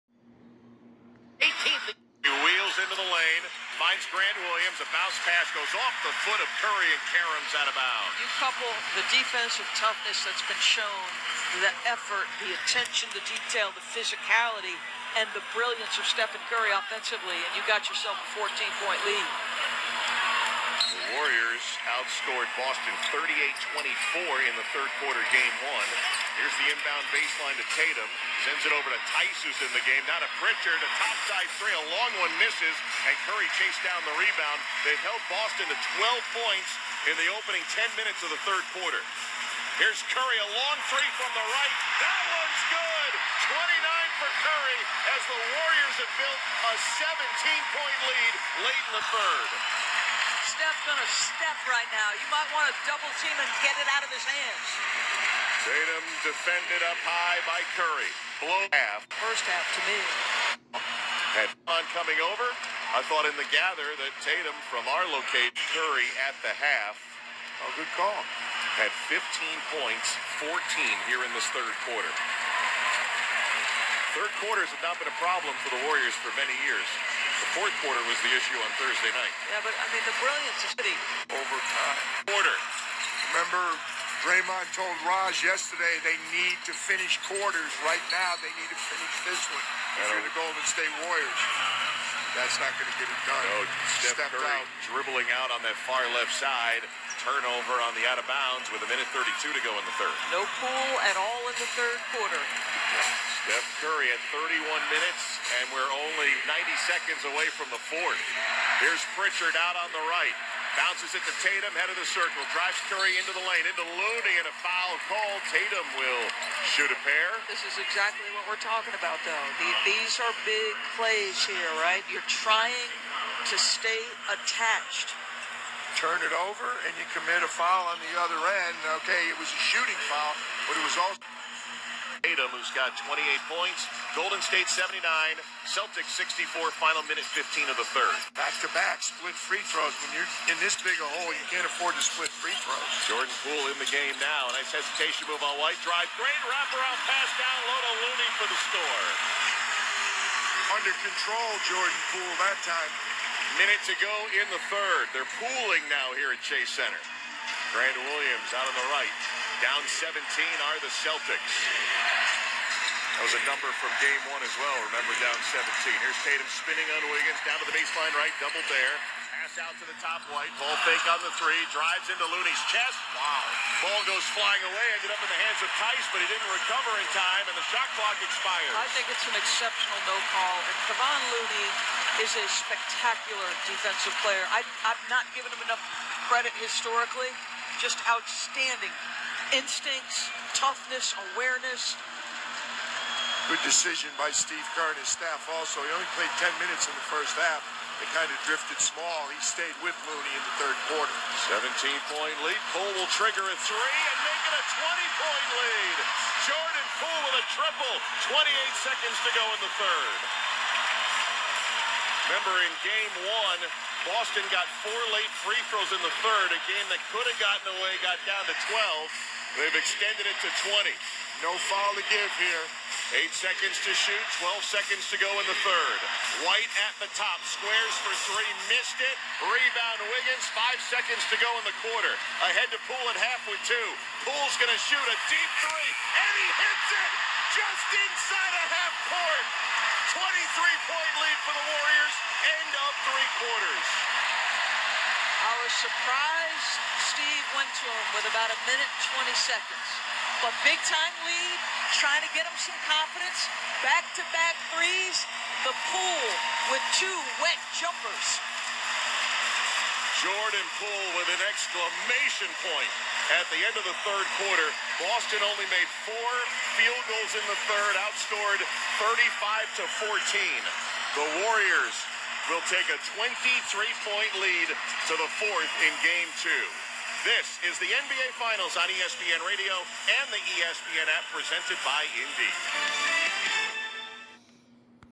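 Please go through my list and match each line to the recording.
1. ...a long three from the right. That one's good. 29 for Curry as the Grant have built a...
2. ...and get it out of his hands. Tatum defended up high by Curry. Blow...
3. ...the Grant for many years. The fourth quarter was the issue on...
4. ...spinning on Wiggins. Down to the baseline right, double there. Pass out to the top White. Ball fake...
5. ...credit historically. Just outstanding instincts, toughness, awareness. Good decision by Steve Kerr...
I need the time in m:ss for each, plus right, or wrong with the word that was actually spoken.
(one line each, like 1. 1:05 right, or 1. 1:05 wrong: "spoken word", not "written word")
1. 0:40 wrong: "Warriors", not "Grant"
2. 0:53 right
3. 1:15 wrong: "Warriors", not "Grant"
4. 2:46 right
5. 3:06 right.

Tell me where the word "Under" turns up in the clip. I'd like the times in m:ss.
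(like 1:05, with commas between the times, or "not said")
2:30.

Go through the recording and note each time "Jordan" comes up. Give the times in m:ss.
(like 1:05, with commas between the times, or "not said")
2:23, 2:31, 3:26, 4:20.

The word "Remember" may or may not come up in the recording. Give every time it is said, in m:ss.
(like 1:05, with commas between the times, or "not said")
1:23, 2:44, 3:32.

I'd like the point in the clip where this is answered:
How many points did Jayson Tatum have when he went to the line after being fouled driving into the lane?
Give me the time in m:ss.
2:13.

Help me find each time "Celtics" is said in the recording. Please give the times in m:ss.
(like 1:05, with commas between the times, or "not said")
2:15, 2:40.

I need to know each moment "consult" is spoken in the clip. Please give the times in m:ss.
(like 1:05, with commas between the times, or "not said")
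not said.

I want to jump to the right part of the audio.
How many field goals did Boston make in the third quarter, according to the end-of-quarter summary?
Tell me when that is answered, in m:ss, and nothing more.
4:26.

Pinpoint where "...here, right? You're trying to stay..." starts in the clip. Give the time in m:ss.
2:01.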